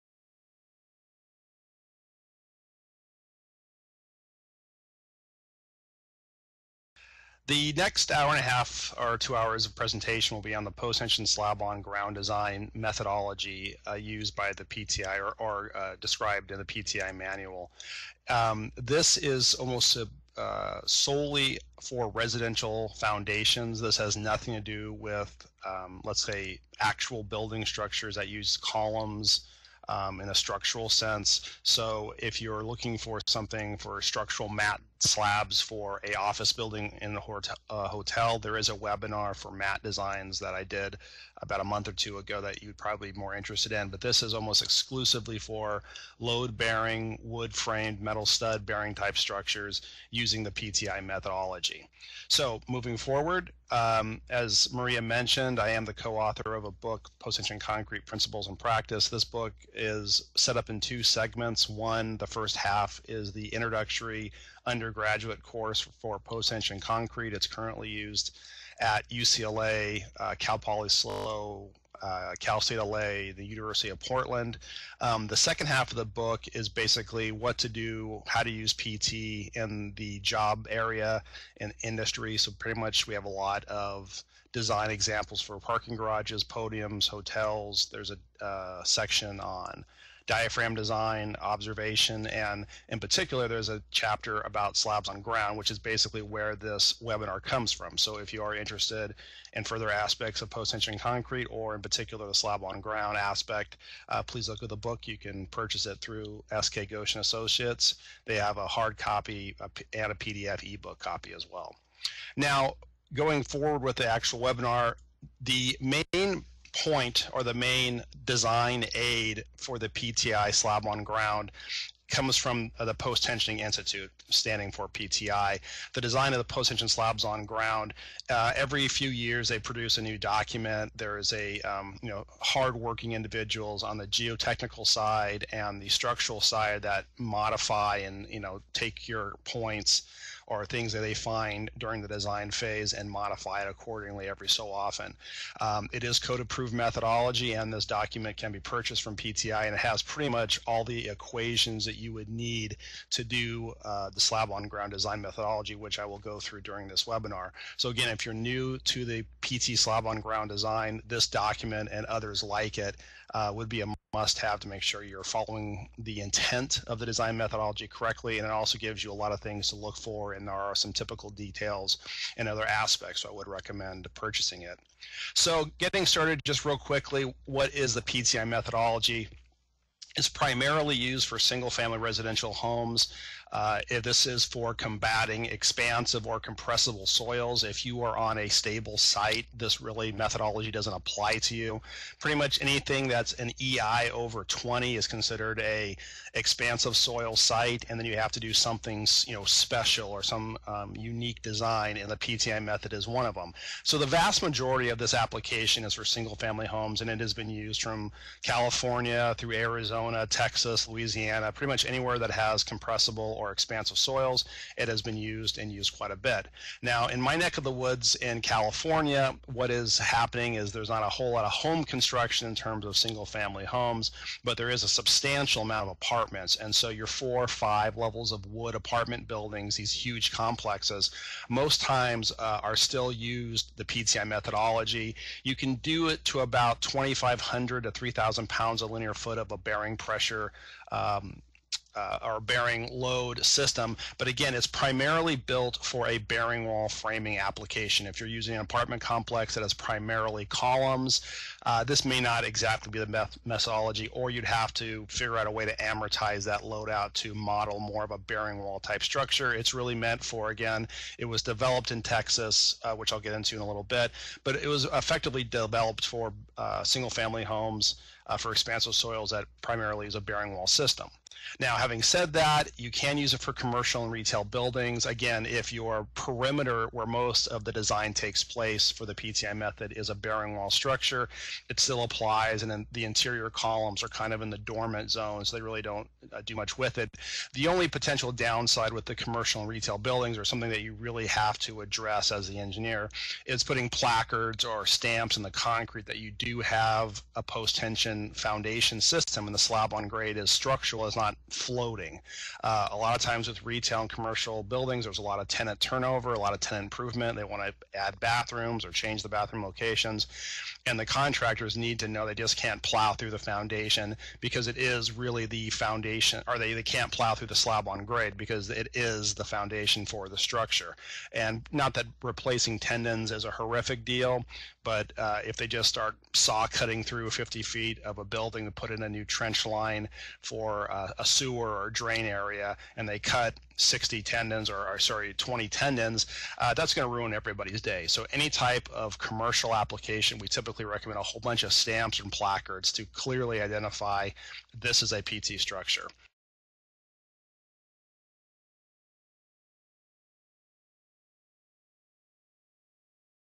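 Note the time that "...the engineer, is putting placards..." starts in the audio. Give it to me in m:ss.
4:52.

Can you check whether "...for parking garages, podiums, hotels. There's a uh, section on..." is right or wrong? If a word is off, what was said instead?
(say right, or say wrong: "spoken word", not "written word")
right.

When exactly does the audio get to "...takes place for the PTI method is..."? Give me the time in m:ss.
4:38.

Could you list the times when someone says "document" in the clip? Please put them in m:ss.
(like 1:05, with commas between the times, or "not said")
2:10, 2:27, 2:41.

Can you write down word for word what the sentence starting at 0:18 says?
Um, this is almost a, uh, solely for residential foundations.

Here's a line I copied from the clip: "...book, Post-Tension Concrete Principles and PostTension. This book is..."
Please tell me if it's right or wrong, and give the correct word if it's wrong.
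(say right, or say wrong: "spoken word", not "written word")
wrong: "Practice", not "PostTension".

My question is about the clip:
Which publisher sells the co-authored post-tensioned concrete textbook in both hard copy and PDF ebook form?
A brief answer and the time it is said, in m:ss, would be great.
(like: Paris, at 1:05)
SK Ghosh Associates, at 1:46.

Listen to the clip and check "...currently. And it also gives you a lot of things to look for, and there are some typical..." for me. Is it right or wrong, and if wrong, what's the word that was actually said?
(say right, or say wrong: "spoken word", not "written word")
wrong: "correctly", not "currently".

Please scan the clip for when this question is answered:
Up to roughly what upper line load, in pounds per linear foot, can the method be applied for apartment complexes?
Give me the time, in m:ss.
3:57.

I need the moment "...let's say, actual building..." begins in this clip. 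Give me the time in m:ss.
0:26.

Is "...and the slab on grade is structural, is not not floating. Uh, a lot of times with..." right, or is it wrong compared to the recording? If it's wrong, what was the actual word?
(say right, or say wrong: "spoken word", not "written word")
right.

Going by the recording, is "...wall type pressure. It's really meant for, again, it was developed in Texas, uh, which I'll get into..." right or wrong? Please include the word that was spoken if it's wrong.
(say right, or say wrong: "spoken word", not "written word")
wrong: "structure", not "pressure".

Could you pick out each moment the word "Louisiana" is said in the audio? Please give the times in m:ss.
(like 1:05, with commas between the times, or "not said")
3:30.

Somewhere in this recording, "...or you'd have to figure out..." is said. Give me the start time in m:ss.
4:14.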